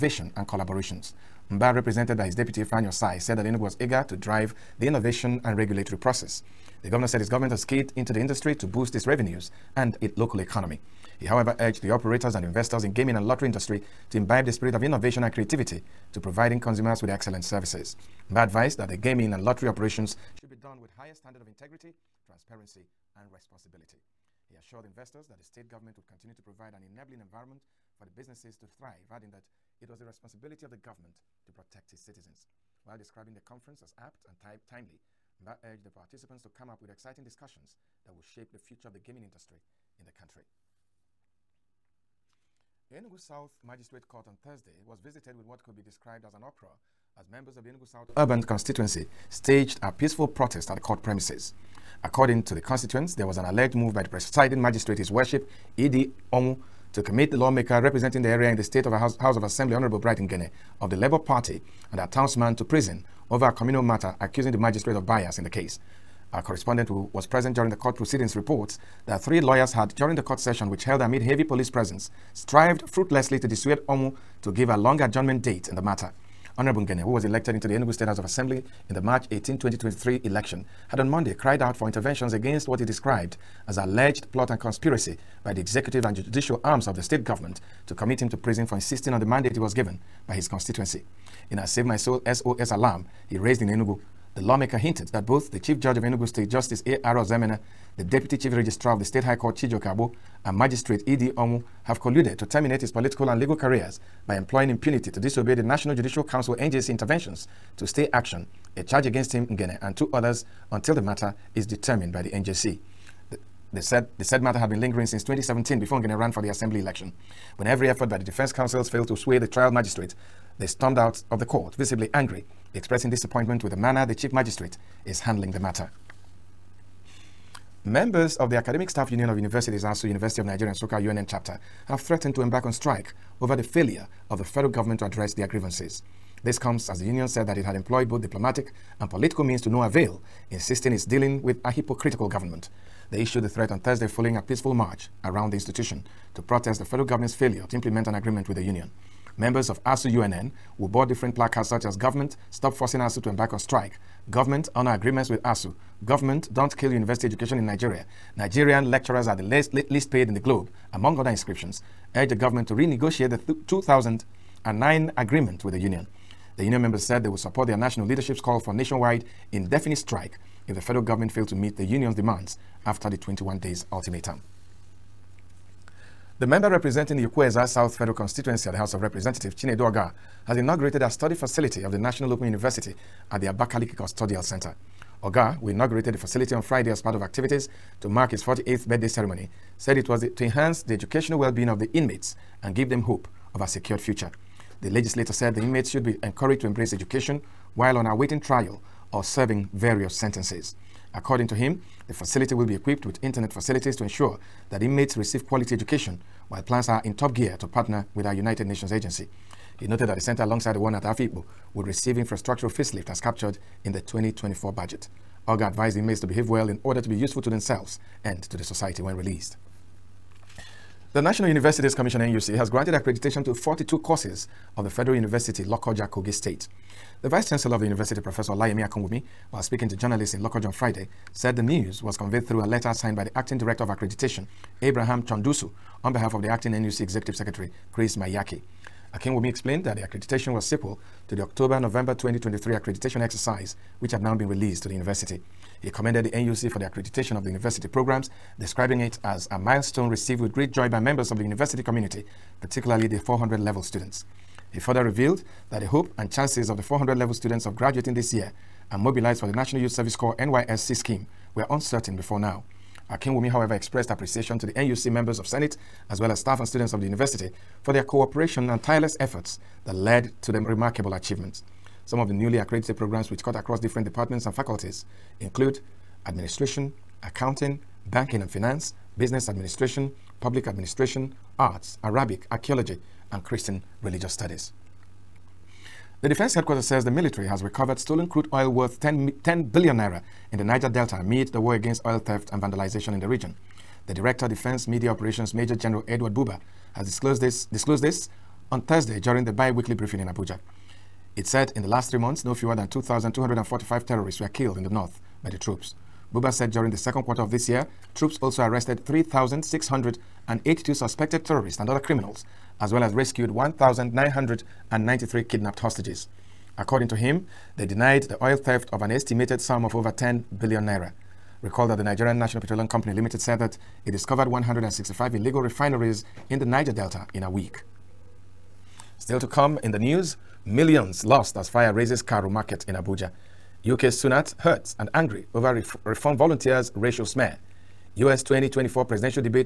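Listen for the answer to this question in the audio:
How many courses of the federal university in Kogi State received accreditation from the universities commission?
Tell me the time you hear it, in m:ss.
3:43.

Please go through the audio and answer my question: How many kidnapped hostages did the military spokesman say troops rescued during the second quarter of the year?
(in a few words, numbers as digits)
1,993.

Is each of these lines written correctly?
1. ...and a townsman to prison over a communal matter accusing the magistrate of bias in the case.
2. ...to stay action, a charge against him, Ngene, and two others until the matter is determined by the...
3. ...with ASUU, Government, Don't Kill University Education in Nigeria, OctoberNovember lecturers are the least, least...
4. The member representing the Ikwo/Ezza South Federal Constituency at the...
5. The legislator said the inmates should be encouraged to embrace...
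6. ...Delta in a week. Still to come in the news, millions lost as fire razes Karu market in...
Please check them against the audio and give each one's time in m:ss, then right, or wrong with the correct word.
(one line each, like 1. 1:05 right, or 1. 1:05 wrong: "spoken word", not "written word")
1. 1:01 right
2. 1:47 right
3. 2:35 wrong: "Nigerian", not "OctoberNovember"
4. 2:56 right
5. 3:14 right
6. 5:26 right.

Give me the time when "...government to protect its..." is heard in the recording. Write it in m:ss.
0:30.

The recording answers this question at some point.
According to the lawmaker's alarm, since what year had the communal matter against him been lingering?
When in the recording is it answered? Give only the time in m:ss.
1:55.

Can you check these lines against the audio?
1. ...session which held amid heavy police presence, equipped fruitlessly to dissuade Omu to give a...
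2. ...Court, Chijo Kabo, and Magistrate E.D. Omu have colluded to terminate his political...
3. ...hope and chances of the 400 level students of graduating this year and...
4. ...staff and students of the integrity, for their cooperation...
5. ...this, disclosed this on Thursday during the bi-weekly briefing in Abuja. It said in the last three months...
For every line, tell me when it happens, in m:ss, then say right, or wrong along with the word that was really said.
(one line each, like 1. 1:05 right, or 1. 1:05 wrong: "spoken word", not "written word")
1. 1:10 wrong: "strived", not "equipped"
2. 1:39 right
3. 4:15 right
4. 4:26 wrong: "university", not "integrity"
5. 4:57 right.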